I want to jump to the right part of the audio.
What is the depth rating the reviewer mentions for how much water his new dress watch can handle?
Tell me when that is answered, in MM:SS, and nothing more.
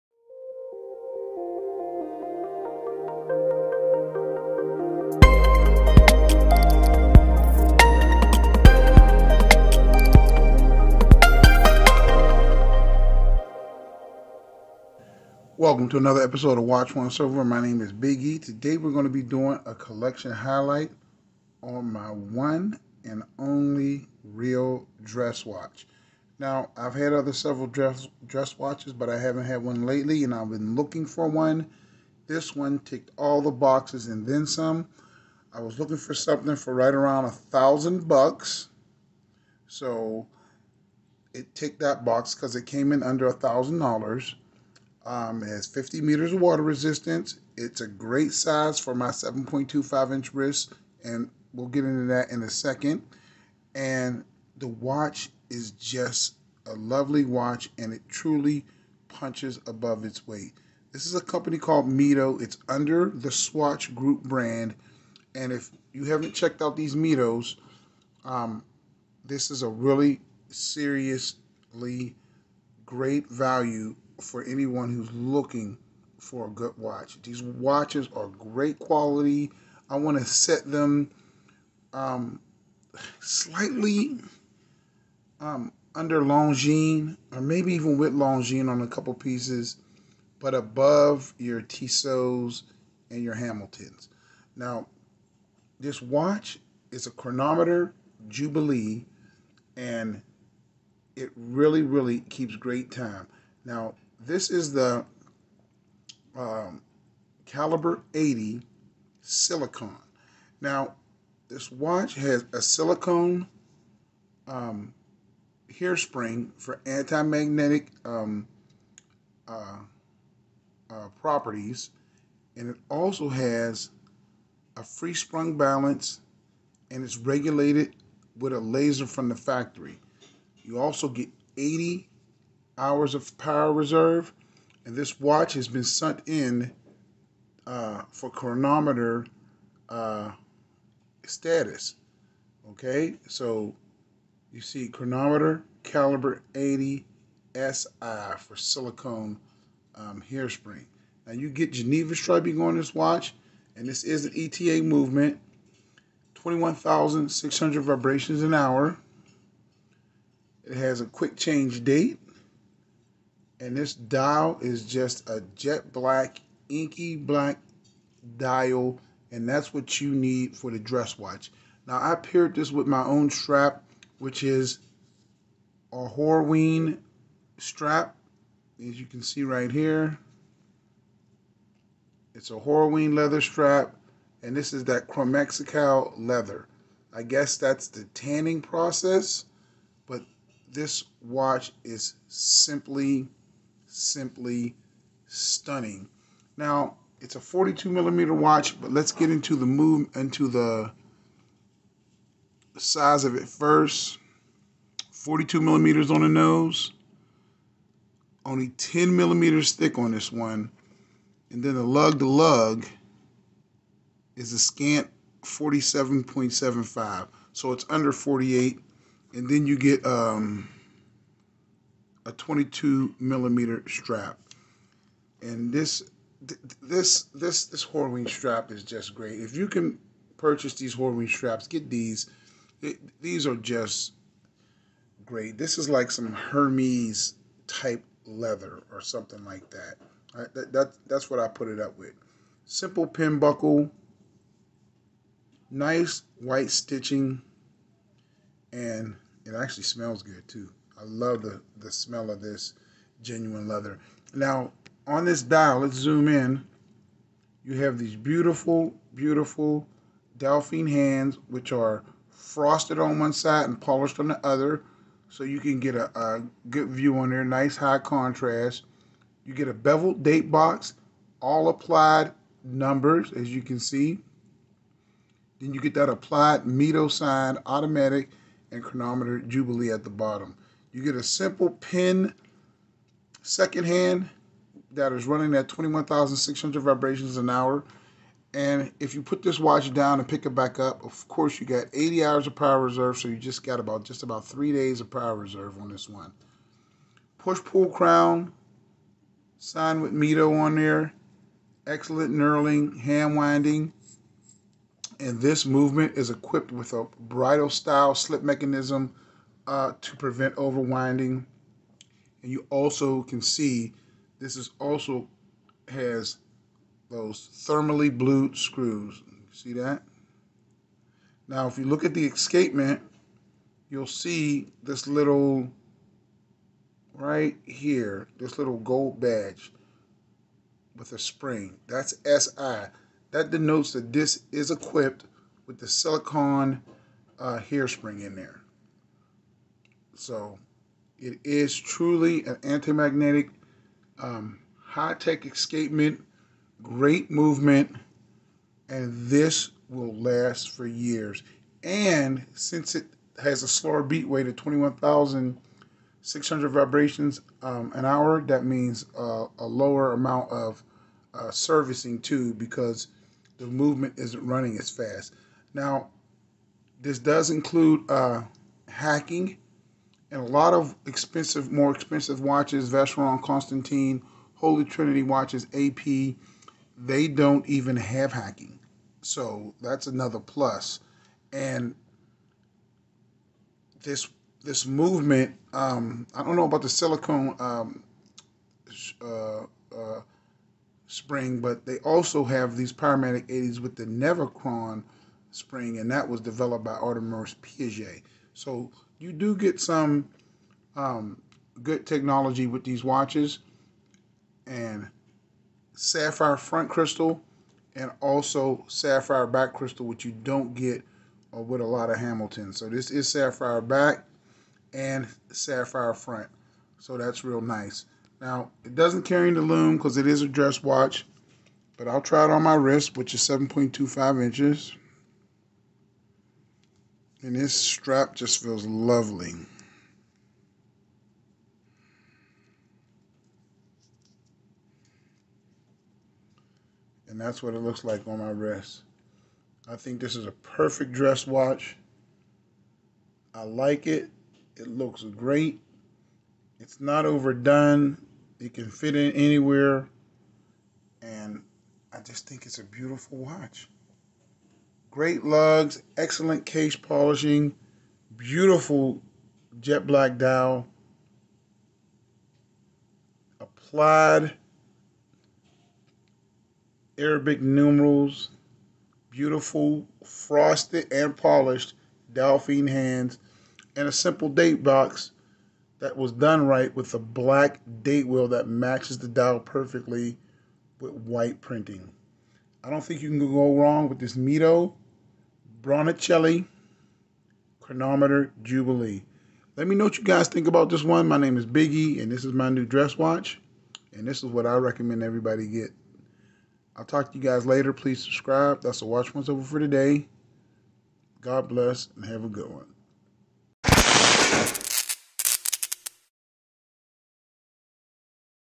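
00:45.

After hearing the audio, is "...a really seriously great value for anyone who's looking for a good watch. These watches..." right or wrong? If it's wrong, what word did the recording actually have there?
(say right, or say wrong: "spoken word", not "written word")
right.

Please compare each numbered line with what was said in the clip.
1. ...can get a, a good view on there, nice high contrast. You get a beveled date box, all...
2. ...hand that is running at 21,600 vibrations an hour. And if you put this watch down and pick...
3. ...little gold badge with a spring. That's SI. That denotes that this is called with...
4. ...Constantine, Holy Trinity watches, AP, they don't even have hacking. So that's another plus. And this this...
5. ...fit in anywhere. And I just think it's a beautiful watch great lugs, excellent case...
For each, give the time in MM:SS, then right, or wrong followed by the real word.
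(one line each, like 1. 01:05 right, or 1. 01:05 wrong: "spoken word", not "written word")
1. 04:25 right
2. 04:43 right
3. 05:28 wrong: "equipped", not "called"
4. 06:13 right
5. 07:28 right.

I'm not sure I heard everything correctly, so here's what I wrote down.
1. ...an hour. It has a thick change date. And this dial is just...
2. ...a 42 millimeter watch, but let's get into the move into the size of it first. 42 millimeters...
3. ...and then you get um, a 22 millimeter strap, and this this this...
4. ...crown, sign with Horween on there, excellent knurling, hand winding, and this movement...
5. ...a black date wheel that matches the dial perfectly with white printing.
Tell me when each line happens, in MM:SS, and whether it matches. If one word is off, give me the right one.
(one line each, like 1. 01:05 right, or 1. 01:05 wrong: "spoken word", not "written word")
1. 02:38 wrong: "quick", not "thick"
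2. 03:17 right
3. 03:39 right
4. 04:57 wrong: "Mido", not "Horween"
5. 07:57 right.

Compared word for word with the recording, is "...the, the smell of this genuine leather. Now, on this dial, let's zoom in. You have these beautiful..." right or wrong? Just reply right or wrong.
right.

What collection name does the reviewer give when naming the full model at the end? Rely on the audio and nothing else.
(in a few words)
Baroncelli.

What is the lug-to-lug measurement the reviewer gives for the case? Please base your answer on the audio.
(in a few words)
47.75 mm.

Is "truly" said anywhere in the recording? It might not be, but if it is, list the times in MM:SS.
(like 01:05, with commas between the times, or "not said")
00:58, 05:41.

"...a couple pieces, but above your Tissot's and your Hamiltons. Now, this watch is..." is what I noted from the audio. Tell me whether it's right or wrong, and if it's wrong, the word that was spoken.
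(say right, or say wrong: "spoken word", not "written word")
right.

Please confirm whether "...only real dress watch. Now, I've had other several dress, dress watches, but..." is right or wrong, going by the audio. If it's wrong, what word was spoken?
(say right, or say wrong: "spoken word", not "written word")
right.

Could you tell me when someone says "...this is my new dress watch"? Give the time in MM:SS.
08:12.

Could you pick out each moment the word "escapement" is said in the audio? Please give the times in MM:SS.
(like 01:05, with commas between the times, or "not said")
05:22, 05:45.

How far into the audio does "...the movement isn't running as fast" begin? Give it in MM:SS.
06:03.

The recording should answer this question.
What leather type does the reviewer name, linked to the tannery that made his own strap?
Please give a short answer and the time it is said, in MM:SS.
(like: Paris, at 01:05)
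Chromexcel, at 03:05.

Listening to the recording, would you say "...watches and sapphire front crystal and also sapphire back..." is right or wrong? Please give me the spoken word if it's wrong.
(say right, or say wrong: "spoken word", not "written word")
right.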